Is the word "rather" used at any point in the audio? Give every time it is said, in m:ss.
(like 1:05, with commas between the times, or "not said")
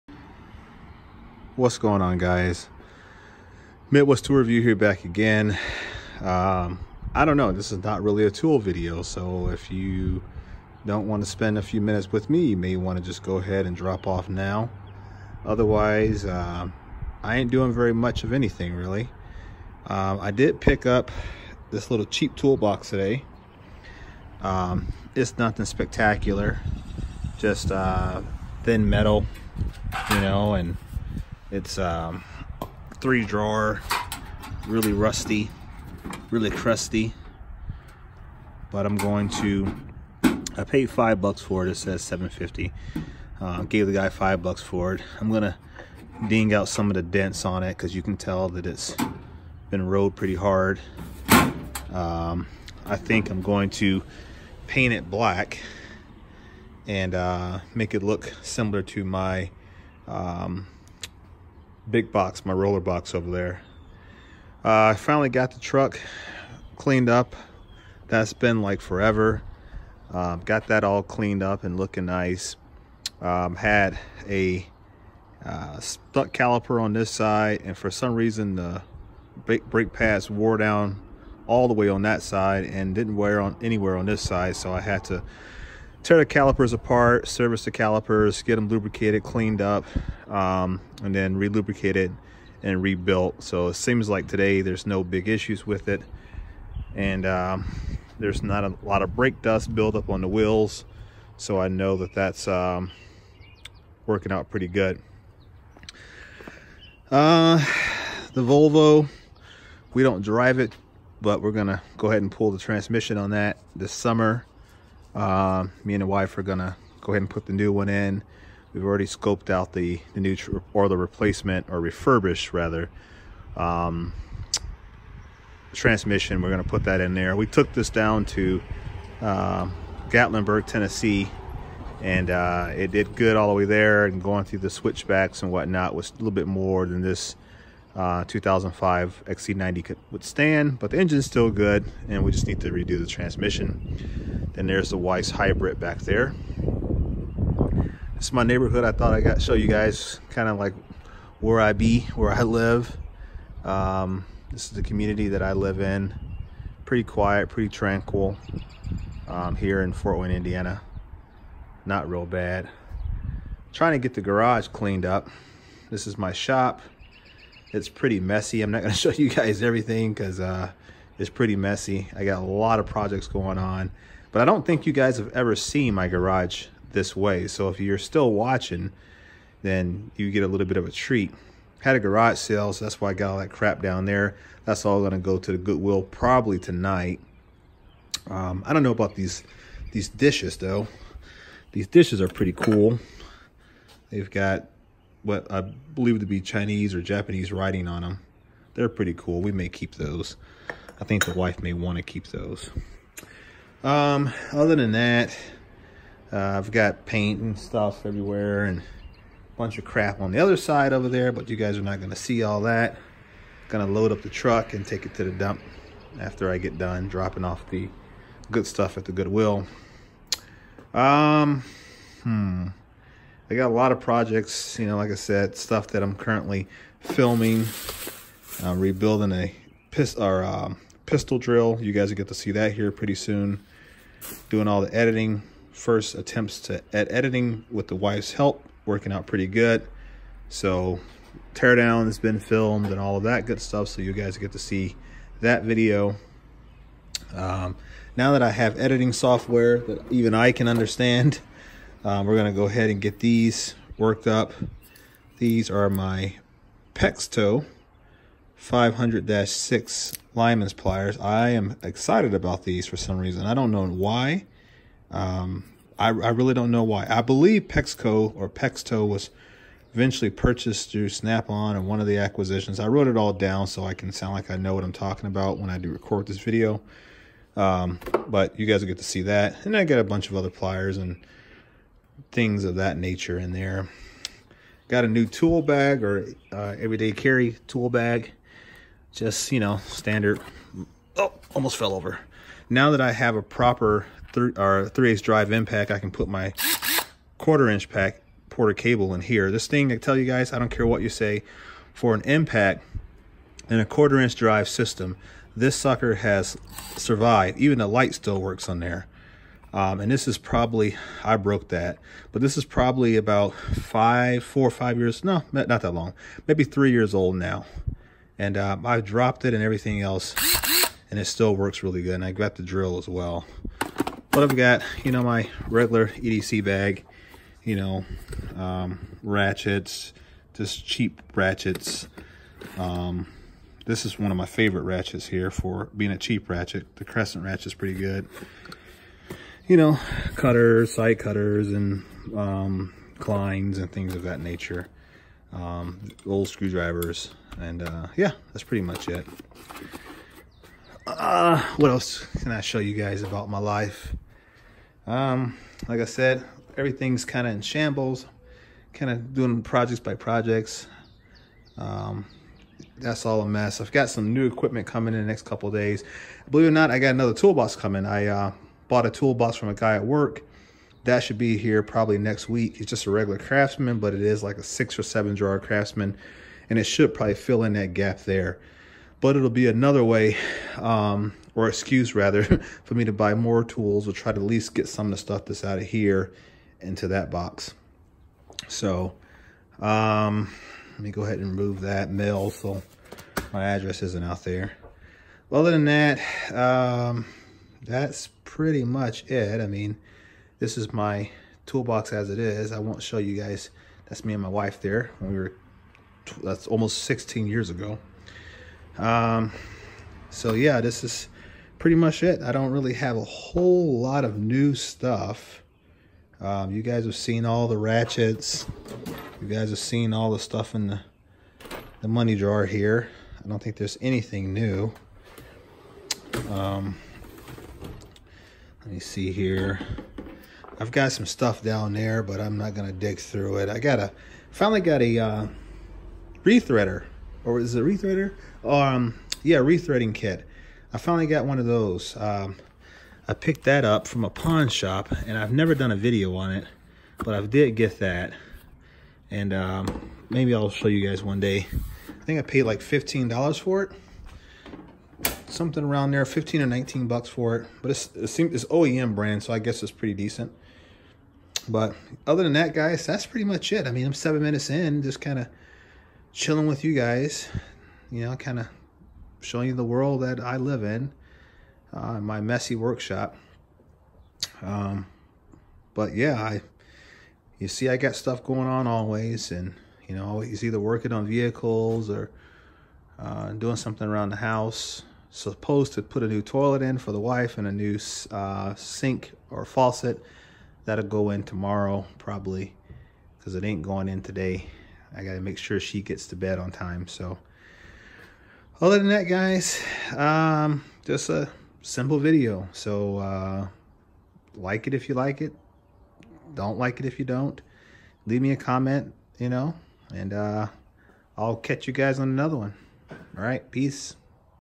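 2:02, 6:22.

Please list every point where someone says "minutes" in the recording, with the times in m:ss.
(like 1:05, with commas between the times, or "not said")
0:11, 7:44.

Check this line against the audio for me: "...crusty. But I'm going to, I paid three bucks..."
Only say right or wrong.
wrong.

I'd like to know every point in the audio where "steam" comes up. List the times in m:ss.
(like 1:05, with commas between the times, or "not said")
not said.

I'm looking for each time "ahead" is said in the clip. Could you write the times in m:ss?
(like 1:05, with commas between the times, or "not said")
0:13, 1:52, 1:57, 4:12, 6:31.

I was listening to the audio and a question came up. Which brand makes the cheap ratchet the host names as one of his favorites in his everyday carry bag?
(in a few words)
Crescent.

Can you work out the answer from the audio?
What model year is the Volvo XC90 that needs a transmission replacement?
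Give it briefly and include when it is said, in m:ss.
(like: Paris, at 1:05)
2005, at 2:18.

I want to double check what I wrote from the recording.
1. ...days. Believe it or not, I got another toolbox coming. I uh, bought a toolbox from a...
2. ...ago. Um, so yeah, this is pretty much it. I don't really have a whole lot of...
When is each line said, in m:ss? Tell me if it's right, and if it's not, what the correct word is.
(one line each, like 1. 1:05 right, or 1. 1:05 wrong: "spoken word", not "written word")
1. 6:05 right
2. 6:47 right.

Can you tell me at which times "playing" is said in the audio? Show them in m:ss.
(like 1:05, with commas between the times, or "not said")
not said.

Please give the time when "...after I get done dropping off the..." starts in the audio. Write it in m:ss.
3:36.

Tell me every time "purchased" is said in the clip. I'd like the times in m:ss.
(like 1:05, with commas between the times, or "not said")
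4:30.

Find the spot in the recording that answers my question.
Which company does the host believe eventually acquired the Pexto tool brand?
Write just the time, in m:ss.
4:31.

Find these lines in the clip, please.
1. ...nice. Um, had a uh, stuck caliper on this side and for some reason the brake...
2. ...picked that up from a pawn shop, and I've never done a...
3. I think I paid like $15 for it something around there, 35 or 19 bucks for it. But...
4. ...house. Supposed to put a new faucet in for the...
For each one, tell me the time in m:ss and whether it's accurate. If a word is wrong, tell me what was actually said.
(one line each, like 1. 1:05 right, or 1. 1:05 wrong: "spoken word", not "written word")
1. 1:12 right
2. 7:23 right
3. 7:32 wrong: "15", not "35"
4. 8:04 wrong: "toilet", not "faucet".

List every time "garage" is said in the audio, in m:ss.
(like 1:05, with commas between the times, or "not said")
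2:44, 2:56, 3:01.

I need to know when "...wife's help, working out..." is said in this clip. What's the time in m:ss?
3:57.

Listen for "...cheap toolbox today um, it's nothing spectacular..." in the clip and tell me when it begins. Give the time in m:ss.
0:22.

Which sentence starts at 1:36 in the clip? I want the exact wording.
And um, there's not a lot of brake dust buildup on the wheels.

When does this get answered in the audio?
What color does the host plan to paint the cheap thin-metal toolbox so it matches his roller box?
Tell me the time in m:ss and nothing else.
0:55.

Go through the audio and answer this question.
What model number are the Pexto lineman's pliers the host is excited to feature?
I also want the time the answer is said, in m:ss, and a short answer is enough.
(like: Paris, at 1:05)
500-6, at 4:18.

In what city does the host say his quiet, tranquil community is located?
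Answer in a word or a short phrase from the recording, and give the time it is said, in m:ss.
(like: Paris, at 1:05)
Fort Wayne, Indiana, at 2:39.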